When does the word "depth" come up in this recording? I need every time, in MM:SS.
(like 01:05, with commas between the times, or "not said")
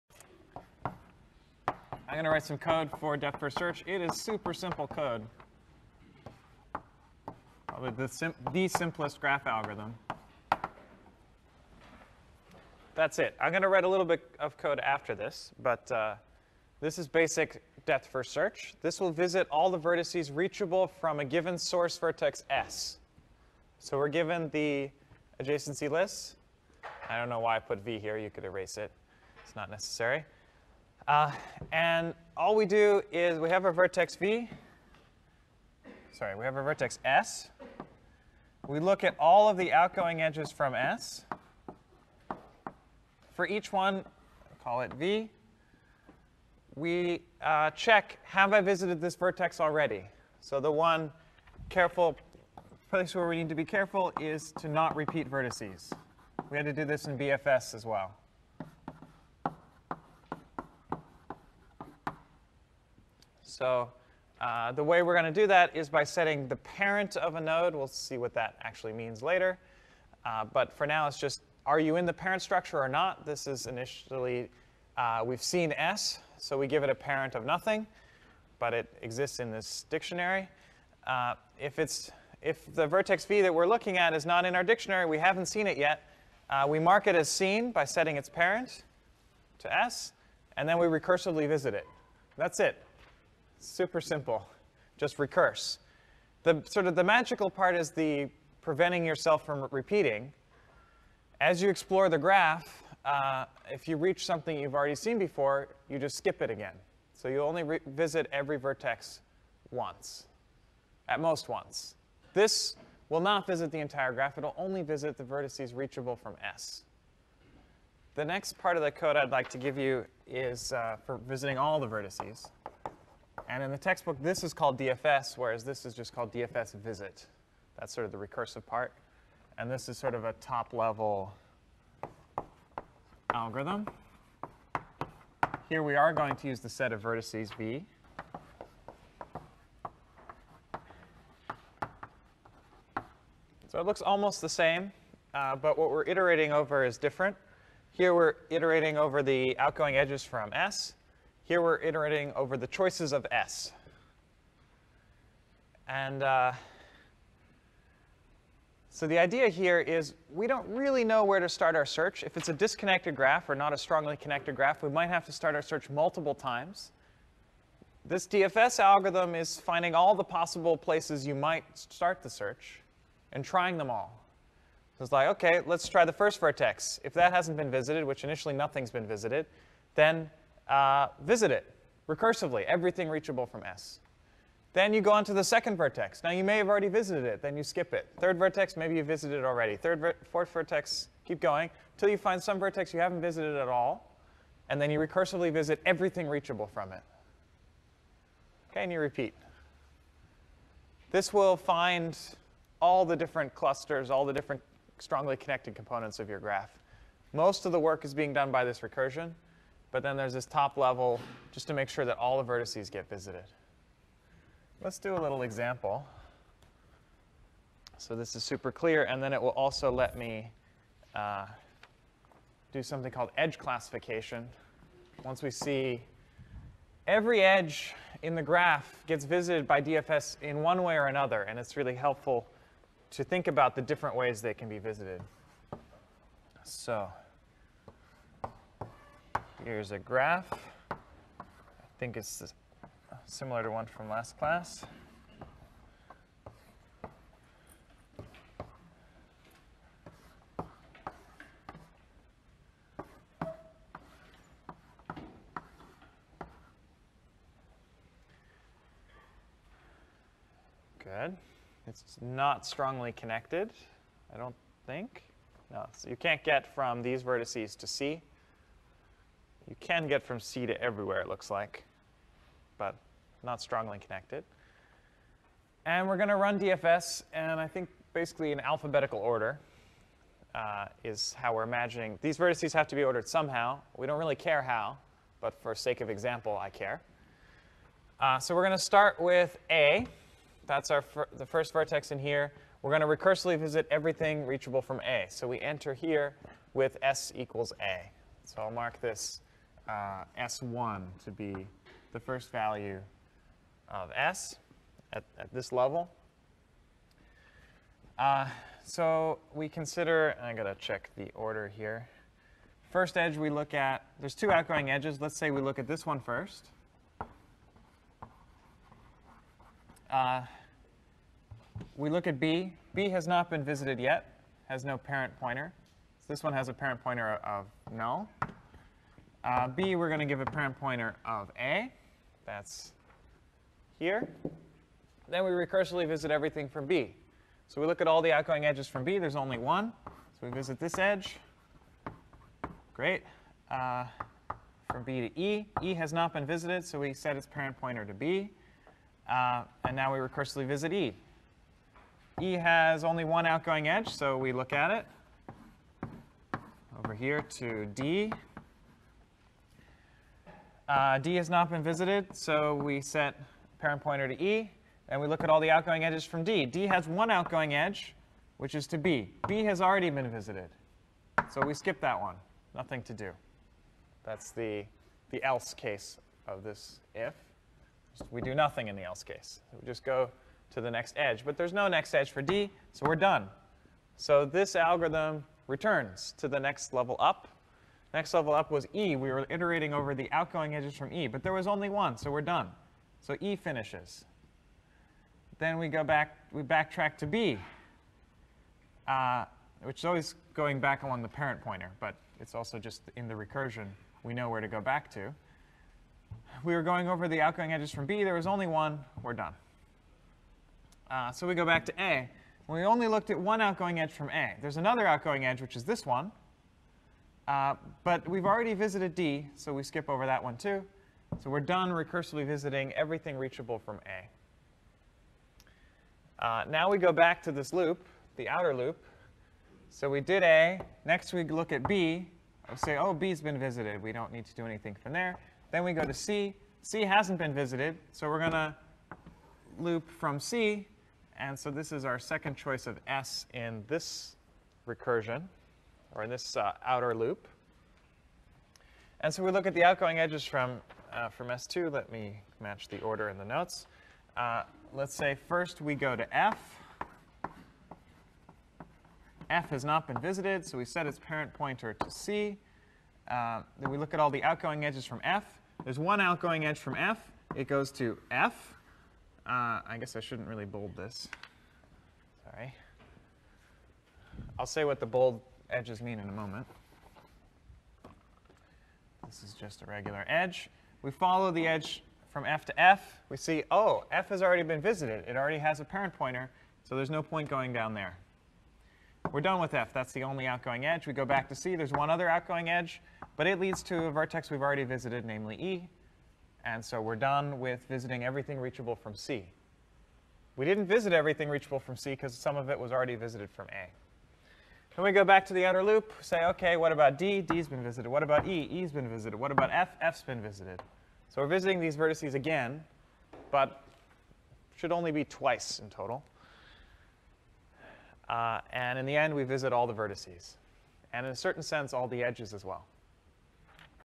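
00:03, 00:17.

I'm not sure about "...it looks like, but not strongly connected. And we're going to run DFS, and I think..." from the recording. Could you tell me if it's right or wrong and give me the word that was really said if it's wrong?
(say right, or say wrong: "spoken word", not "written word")
right.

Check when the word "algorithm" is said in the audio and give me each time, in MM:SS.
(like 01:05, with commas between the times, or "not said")
00:09, 02:13, 02:48, 06:24.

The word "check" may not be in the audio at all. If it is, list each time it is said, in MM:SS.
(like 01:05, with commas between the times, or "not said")
00:47, 05:10.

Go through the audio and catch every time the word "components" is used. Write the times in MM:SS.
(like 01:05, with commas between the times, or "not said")
03:25.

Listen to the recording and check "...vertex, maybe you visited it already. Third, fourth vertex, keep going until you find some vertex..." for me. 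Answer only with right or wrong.
right.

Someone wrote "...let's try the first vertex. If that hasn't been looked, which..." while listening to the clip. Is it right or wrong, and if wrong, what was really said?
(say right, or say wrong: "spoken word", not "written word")
wrong: "visited", not "looked".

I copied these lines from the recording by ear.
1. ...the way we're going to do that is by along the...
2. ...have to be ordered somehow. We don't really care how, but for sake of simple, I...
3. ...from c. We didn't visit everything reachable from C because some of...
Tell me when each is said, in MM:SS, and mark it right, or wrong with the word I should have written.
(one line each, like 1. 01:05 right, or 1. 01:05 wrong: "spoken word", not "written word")
1. 01:04 wrong: "setting", not "along"
2. 04:42 wrong: "example", not "simple"
3. 08:18 right.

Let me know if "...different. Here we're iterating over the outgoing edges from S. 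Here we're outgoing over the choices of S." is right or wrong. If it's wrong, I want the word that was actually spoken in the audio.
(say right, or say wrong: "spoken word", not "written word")
wrong: "iterating", not "outgoing".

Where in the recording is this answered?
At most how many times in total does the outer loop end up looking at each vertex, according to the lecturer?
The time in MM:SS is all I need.
08:35.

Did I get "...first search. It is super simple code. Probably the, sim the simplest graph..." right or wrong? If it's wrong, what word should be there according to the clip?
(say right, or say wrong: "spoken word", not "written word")
right.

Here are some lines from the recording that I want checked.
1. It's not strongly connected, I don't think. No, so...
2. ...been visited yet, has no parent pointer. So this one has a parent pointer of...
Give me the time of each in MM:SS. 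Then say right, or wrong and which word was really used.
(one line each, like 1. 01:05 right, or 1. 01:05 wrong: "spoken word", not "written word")
1. 04:21 right
2. 05:23 right.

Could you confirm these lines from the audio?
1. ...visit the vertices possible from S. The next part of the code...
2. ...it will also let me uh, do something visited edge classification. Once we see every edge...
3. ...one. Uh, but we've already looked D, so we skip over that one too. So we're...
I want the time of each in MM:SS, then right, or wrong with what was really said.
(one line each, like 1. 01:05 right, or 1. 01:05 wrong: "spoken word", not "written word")
1. 01:54 wrong: "reachable", not "possible"
2. 03:39 wrong: "called", not "visited"
3. 06:56 wrong: "visited", not "looked".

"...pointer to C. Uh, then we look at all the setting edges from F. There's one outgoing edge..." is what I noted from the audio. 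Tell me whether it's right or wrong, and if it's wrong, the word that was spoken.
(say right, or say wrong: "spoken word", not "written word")
wrong: "outgoing", not "setting".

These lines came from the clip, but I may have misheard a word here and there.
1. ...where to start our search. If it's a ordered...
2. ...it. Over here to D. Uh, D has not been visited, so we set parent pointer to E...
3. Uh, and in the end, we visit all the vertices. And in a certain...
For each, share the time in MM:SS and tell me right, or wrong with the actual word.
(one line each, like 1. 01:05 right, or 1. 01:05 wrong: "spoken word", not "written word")
1. 02:41 wrong: "disconnected", not "ordered"
2. 05:54 right
3. 08:38 right.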